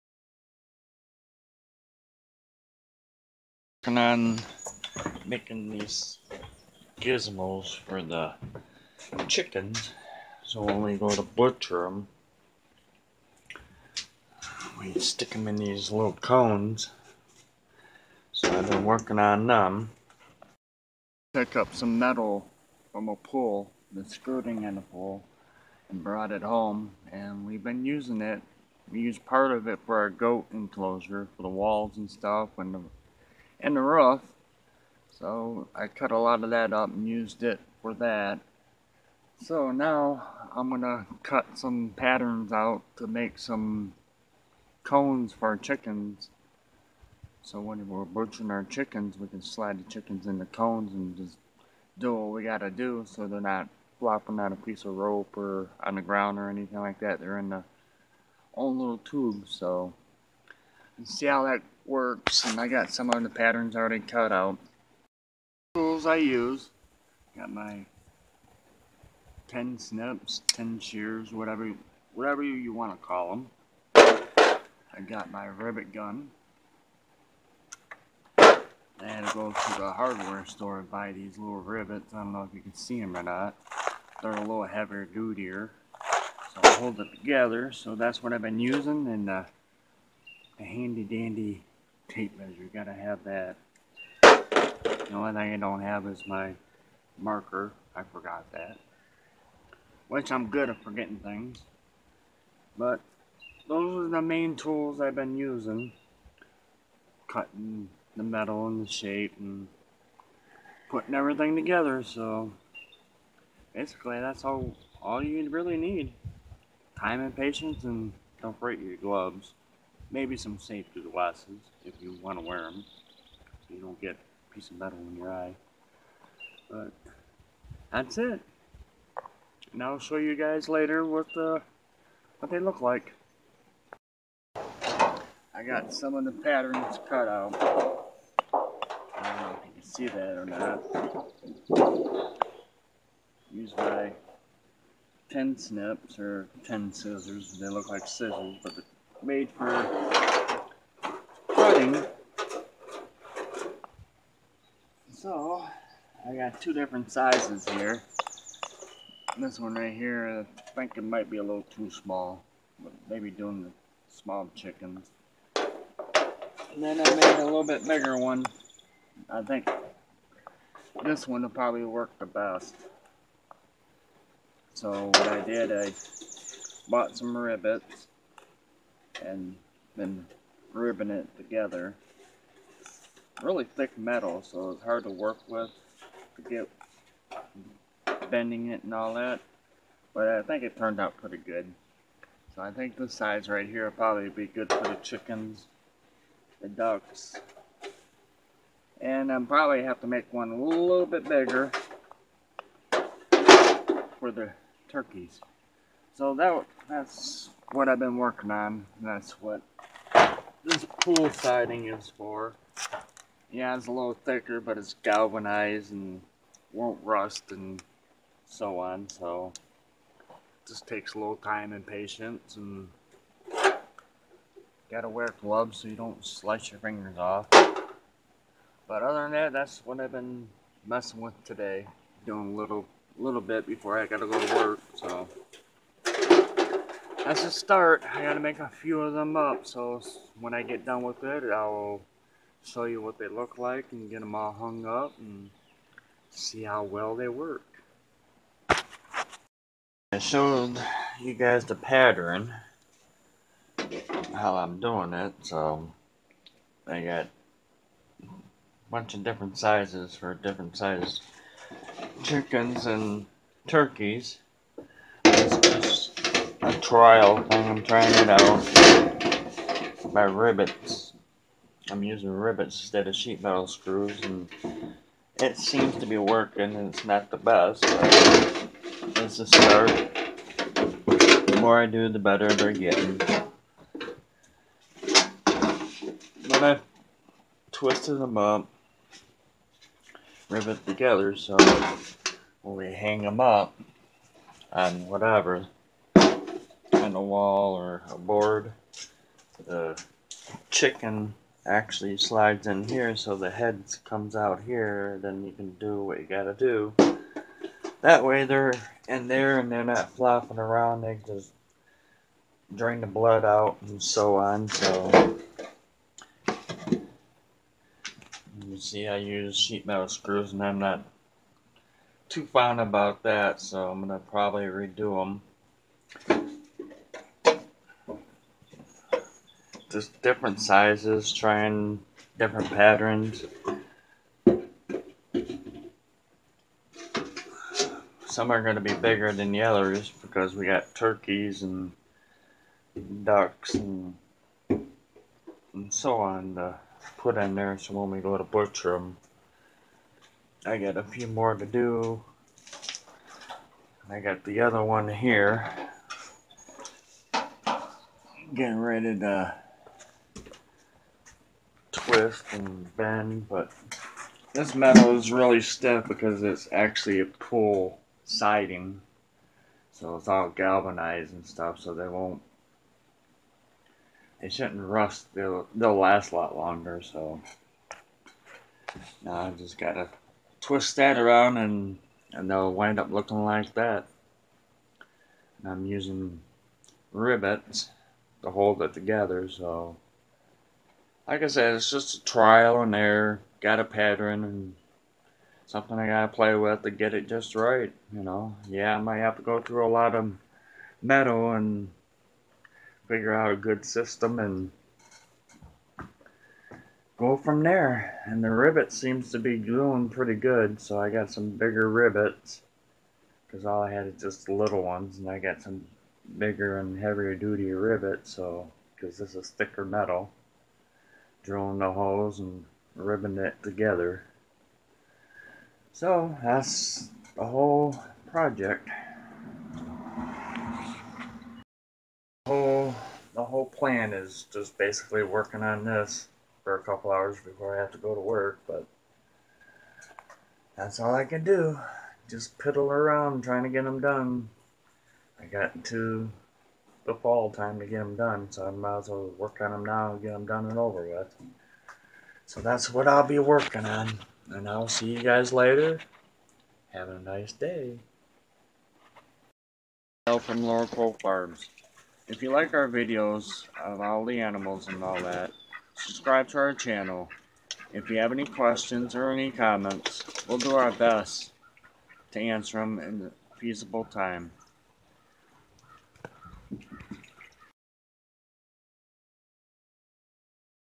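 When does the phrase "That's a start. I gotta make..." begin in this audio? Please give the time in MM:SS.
03:57.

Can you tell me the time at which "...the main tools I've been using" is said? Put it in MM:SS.
01:44.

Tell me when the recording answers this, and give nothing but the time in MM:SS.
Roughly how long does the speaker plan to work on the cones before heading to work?
07:16.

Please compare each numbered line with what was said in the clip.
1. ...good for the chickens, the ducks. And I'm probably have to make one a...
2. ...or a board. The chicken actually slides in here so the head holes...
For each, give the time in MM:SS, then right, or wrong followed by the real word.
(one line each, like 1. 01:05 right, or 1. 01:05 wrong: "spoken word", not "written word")
1. 03:14 right
2. 04:57 wrong: "comes", not "holes".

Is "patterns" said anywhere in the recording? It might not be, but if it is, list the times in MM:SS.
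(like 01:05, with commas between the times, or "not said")
00:41, 01:03, 02:16, 04:11, 05:32, 06:33.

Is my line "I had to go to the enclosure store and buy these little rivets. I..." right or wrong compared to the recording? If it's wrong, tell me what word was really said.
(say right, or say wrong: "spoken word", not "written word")
wrong: "hardware", not "enclosure".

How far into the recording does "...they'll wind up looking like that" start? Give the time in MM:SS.
06:22.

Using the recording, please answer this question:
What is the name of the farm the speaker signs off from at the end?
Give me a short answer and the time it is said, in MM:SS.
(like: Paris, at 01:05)
Laurel Cove Farms, at 07:40.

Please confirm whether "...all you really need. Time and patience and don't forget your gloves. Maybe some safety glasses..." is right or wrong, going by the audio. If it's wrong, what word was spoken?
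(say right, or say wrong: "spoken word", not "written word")
right.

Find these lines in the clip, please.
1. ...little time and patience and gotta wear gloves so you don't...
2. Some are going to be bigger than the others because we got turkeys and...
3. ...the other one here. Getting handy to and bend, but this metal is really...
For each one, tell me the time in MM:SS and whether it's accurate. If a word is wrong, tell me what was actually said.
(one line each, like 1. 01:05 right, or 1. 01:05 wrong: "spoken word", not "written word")
1. 03:41 right
2. 05:38 right
3. 05:54 wrong: "ready", not "handy".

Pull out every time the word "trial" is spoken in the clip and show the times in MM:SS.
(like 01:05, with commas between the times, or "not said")
04:26, 06:32.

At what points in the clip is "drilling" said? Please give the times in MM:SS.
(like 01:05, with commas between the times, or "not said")
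07:01.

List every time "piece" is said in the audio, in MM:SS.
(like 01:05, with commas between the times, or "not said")
00:54, 02:04.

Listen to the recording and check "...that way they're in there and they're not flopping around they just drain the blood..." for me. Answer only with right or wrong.
right.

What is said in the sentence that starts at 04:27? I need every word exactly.
I'm trying it out by rivets.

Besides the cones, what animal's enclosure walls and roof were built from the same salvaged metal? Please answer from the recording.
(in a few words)
Goat.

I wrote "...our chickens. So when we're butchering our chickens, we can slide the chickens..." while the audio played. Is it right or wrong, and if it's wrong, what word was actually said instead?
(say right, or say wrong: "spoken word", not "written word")
right.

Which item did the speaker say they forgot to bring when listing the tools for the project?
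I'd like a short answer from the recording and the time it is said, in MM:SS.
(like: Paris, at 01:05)
Marker, at 01:37.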